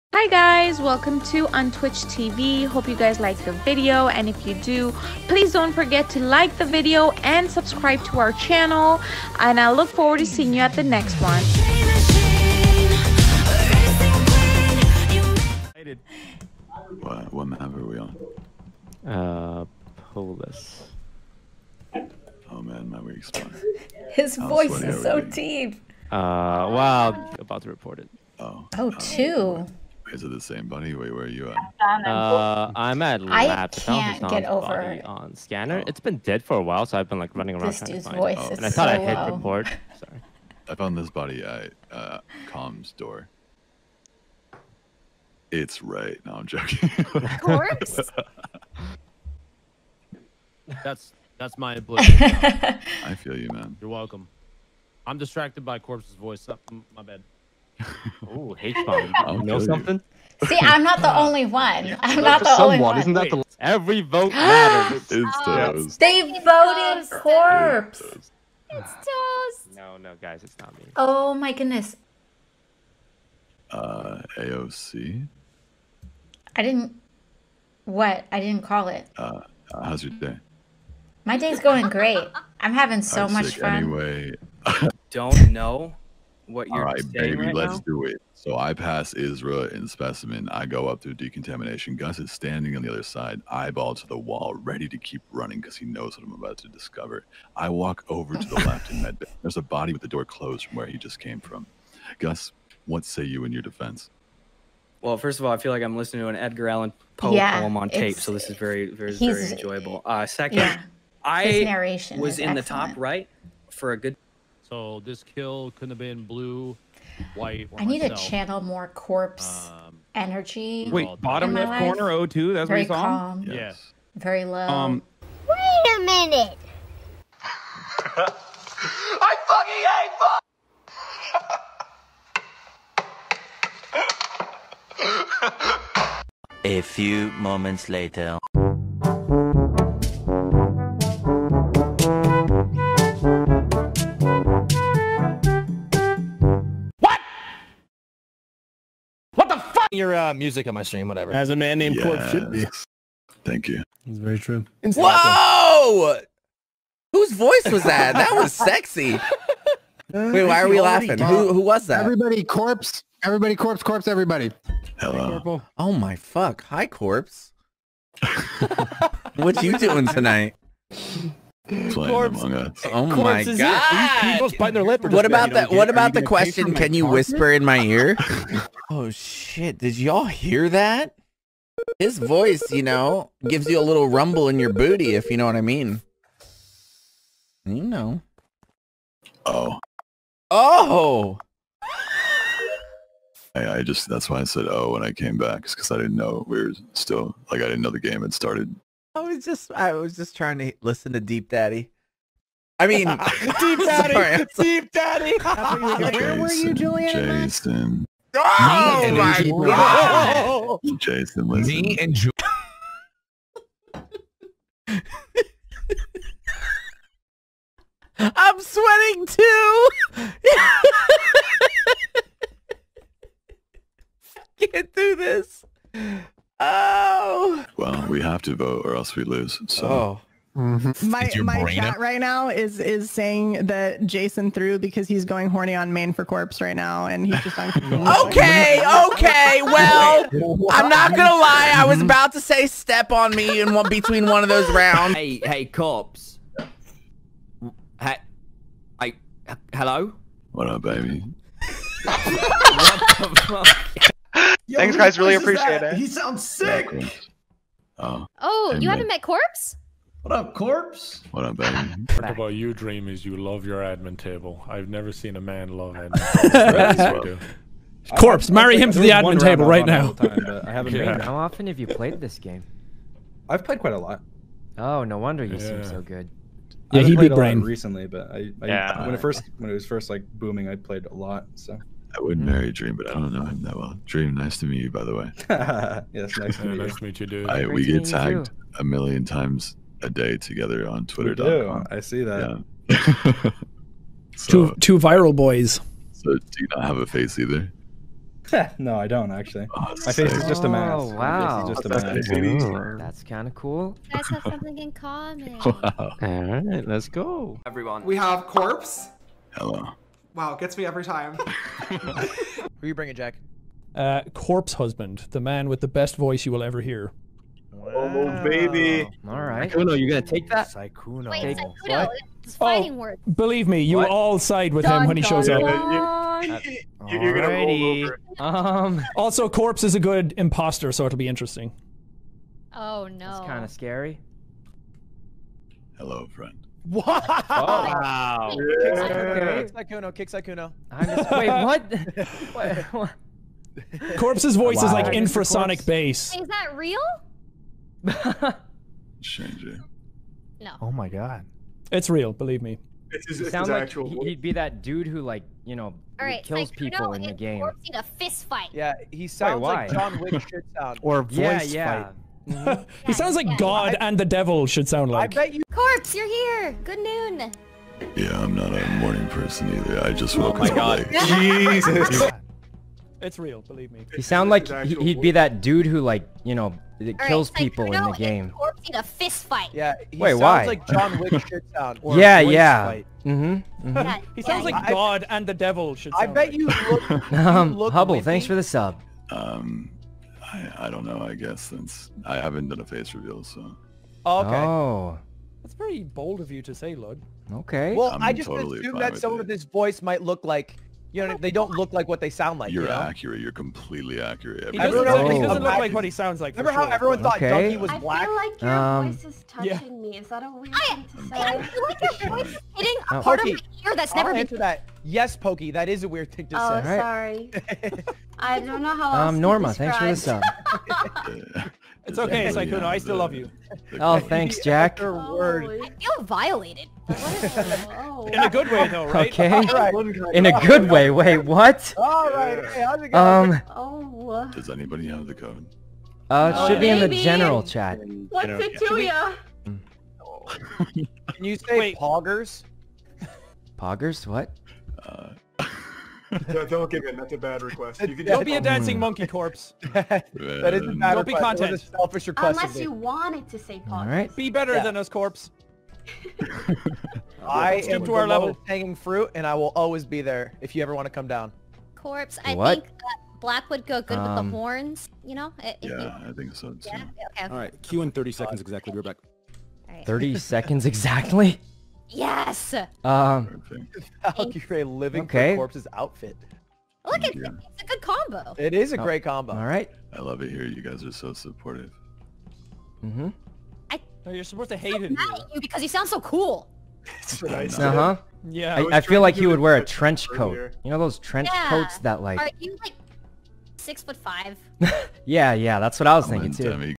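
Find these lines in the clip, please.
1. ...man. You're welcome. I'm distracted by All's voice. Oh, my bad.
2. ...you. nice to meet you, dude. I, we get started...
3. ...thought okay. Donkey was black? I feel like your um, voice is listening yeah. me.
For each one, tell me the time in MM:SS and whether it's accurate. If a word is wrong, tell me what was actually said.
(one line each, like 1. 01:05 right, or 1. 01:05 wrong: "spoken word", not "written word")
1. 00:53 wrong: "Corpse", not "All"
2. 04:46 wrong: "tagged", not "started"
3. 06:47 wrong: "touching", not "listening".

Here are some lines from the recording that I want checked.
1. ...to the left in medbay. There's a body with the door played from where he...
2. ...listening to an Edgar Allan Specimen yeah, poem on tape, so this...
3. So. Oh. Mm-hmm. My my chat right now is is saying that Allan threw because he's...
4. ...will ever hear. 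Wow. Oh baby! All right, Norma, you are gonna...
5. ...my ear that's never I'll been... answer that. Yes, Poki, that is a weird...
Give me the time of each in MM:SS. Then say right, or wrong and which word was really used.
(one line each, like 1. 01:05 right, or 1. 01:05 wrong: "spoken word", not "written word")
1. 01:38 wrong: "closed", not "played"
2. 01:45 wrong: "Poe", not "Specimen"
3. 03:49 wrong: "Jason", not "Allan"
4. 05:16 wrong: "Sykkuno", not "Norma"
5. 06:53 right.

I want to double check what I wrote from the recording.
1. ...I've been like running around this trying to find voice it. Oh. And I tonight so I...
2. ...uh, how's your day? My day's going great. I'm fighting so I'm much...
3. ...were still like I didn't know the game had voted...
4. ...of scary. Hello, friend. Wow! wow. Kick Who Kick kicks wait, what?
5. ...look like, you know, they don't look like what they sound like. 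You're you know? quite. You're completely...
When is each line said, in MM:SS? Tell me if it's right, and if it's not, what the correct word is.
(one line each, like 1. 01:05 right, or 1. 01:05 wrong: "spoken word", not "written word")
1. 00:36 wrong: "thought", not "tonight"
2. 01:19 wrong: "having", not "fighting"
3. 03:16 wrong: "started", not "voted"
4. 05:33 wrong: "Kicks", not "Who"
5. 06:40 wrong: "accurate", not "quite".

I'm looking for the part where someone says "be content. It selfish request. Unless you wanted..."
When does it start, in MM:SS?
07:31.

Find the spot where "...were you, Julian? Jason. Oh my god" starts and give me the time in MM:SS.
03:26.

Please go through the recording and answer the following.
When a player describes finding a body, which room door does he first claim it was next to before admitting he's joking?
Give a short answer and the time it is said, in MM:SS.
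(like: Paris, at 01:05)
comms door, at 00:42.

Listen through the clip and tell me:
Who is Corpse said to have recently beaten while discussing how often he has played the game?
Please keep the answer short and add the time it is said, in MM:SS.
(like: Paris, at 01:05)
Brain, at 04:37.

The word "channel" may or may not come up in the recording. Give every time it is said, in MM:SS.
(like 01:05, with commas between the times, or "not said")
00:08, 01:58.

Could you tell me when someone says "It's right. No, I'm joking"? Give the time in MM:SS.
00:45.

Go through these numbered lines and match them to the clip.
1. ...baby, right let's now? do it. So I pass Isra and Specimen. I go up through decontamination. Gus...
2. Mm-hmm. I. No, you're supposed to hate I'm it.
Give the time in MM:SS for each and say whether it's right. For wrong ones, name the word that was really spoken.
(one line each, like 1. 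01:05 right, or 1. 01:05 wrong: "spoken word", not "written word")
1. 01:27 right
2. 08:03 right.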